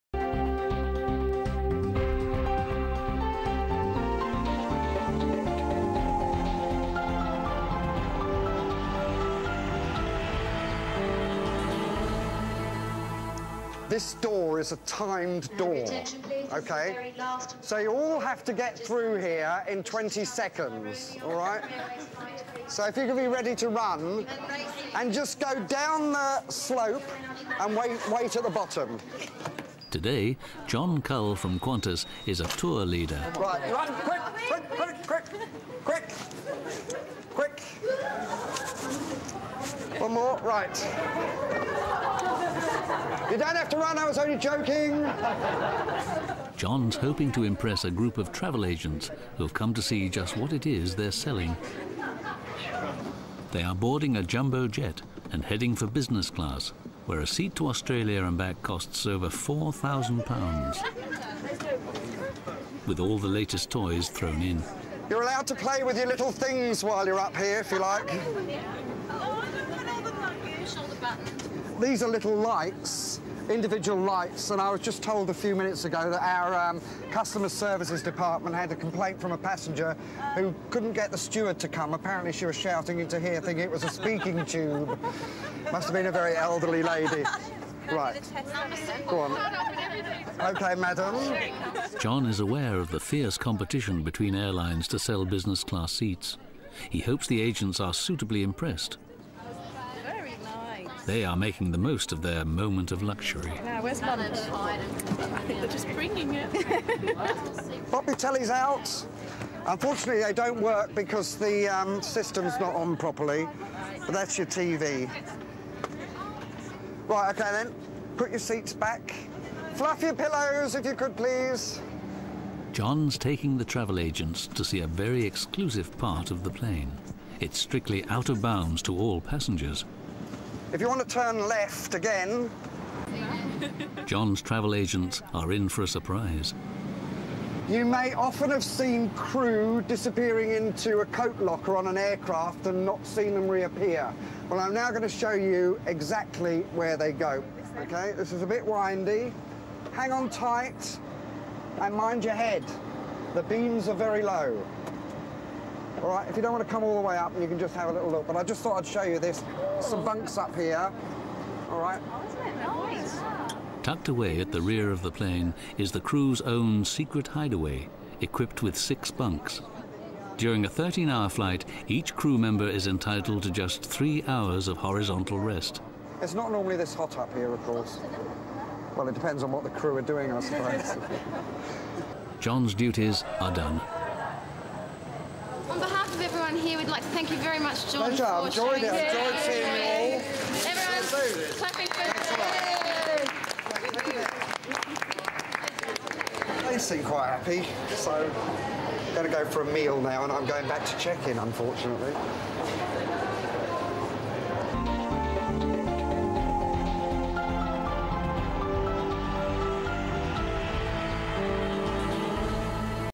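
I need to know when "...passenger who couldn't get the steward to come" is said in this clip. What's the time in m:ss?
1:19.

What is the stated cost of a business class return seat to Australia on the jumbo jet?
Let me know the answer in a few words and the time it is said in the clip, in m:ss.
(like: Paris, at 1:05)
Over £4,000, at 0:59.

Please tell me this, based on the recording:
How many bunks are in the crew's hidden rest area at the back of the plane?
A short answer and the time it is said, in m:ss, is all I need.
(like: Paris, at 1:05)
6, at 2:48.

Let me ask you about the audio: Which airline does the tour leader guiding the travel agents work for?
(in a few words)
Qantas.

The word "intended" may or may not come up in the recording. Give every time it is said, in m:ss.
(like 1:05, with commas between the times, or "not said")
not said.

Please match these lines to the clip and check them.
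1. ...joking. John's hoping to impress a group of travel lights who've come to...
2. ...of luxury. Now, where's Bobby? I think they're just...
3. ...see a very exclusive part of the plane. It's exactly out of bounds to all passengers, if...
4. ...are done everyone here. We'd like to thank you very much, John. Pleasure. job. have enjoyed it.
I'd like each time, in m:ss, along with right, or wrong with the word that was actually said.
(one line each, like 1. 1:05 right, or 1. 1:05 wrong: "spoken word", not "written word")
1. 0:44 wrong: "agents", not "lights"
2. 1:42 right
3. 2:04 wrong: "strictly", not "exactly"
4. 3:03 right.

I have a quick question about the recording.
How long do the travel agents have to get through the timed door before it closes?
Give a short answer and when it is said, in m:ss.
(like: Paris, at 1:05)
20 seconds, at 0:19.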